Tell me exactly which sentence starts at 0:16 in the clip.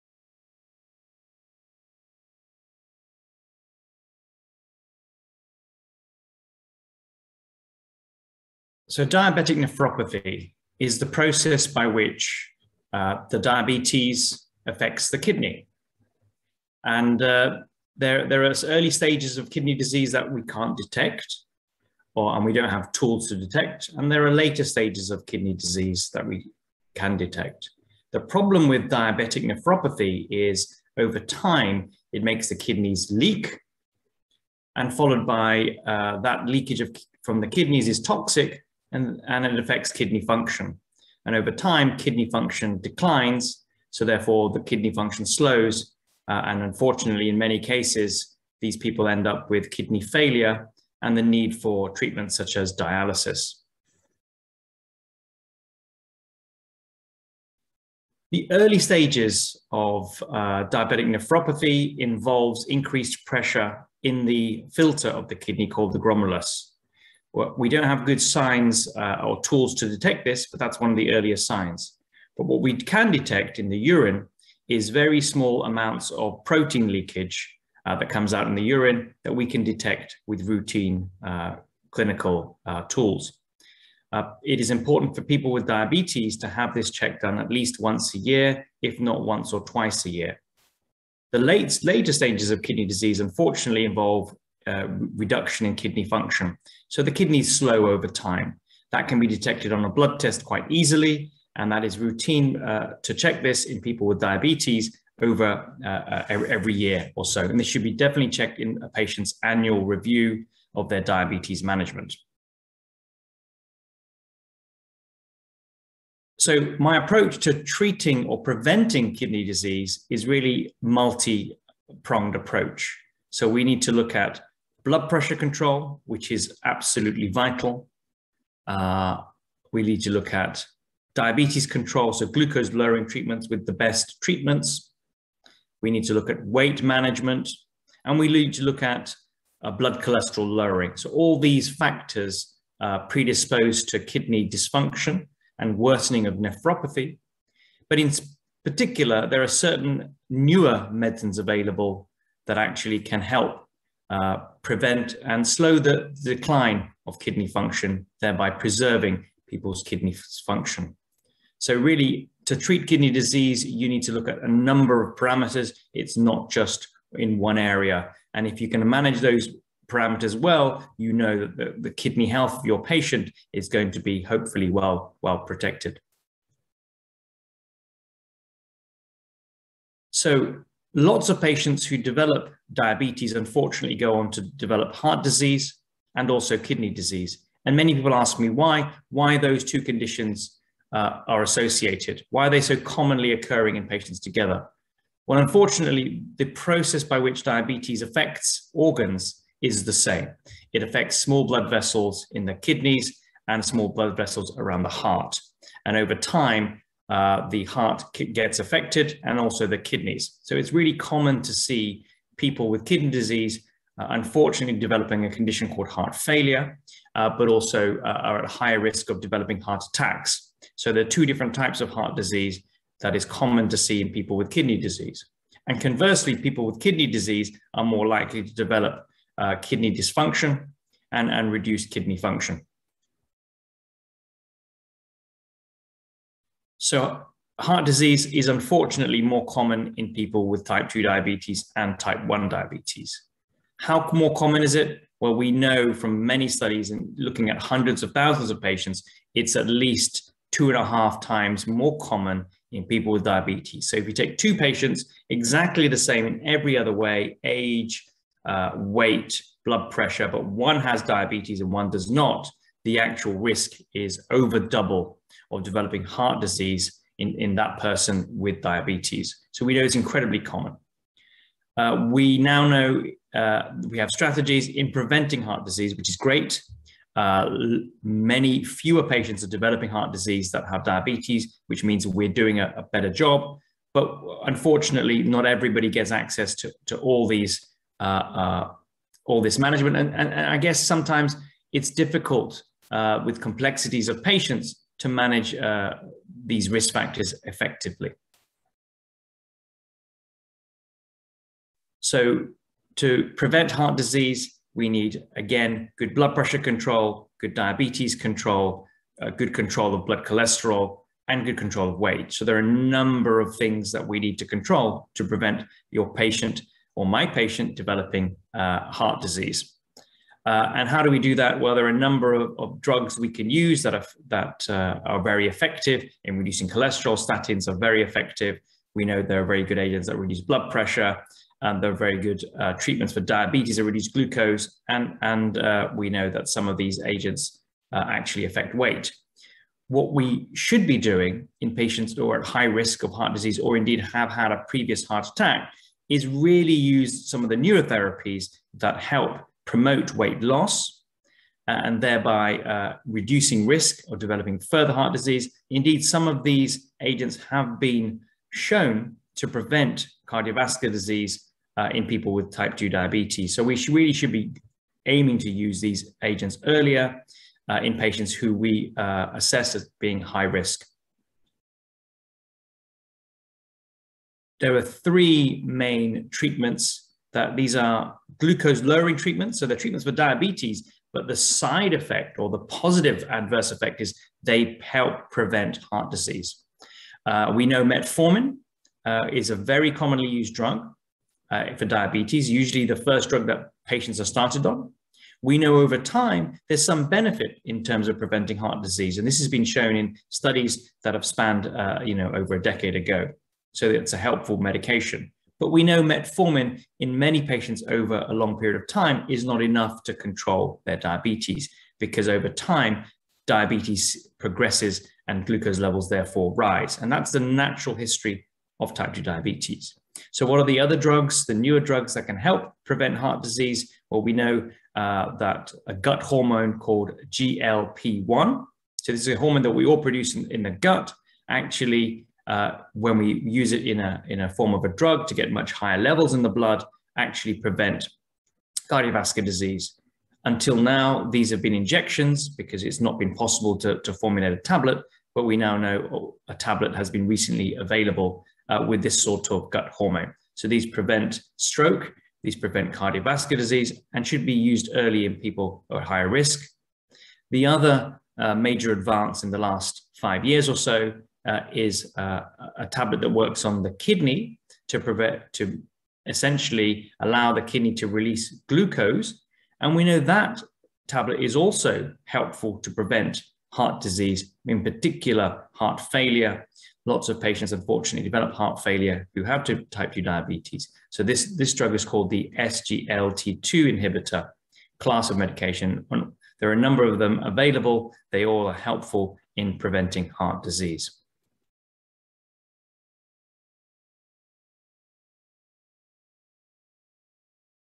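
And uh, there, there are early stages of kidney disease that we can't detect, or, and we don't have tools to detect.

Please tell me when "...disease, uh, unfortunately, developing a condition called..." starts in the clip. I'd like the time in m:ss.
3:33.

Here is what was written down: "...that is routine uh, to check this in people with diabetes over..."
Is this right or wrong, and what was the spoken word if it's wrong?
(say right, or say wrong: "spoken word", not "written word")
right.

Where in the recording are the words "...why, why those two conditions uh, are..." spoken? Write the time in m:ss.
3:08.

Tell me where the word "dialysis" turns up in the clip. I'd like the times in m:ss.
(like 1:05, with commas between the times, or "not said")
0:52.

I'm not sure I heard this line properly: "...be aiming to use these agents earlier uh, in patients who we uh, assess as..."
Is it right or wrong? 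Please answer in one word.
right.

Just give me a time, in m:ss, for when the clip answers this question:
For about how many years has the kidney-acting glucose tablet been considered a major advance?
7:40.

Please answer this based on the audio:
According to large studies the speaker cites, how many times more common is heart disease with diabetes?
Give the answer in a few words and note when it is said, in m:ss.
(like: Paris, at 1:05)
2.5 times, at 4:10.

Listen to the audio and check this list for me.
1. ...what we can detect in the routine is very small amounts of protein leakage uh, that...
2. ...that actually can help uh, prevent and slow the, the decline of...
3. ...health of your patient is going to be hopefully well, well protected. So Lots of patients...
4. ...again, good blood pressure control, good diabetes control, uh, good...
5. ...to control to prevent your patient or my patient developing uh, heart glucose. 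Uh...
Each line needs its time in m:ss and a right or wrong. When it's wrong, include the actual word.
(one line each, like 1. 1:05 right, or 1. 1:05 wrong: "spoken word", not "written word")
1. 1:12 wrong: "urine", not "routine"
2. 2:32 right
3. 2:52 right
4. 5:05 right
5. 5:14 wrong: "disease", not "glucose".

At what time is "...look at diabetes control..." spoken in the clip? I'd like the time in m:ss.
2:10.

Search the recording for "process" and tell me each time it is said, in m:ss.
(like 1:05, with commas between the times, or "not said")
0:11, 3:16.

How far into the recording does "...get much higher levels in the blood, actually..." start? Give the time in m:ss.
7:15.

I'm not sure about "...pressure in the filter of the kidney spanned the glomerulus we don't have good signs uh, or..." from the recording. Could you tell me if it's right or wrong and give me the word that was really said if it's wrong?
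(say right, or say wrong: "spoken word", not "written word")
wrong: "called", not "spanned".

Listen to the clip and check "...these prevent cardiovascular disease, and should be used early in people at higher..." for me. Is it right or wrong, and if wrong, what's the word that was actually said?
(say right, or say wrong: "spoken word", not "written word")
right.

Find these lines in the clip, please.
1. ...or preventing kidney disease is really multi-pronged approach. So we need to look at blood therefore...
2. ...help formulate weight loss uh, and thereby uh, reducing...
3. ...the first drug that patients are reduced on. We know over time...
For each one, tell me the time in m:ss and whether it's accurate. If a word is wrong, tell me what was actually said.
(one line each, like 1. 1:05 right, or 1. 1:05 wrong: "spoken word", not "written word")
1. 1:58 wrong: "pressure", not "therefore"
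2. 5:48 wrong: "promote", not "formulate"
3. 6:32 wrong: "started", not "reduced".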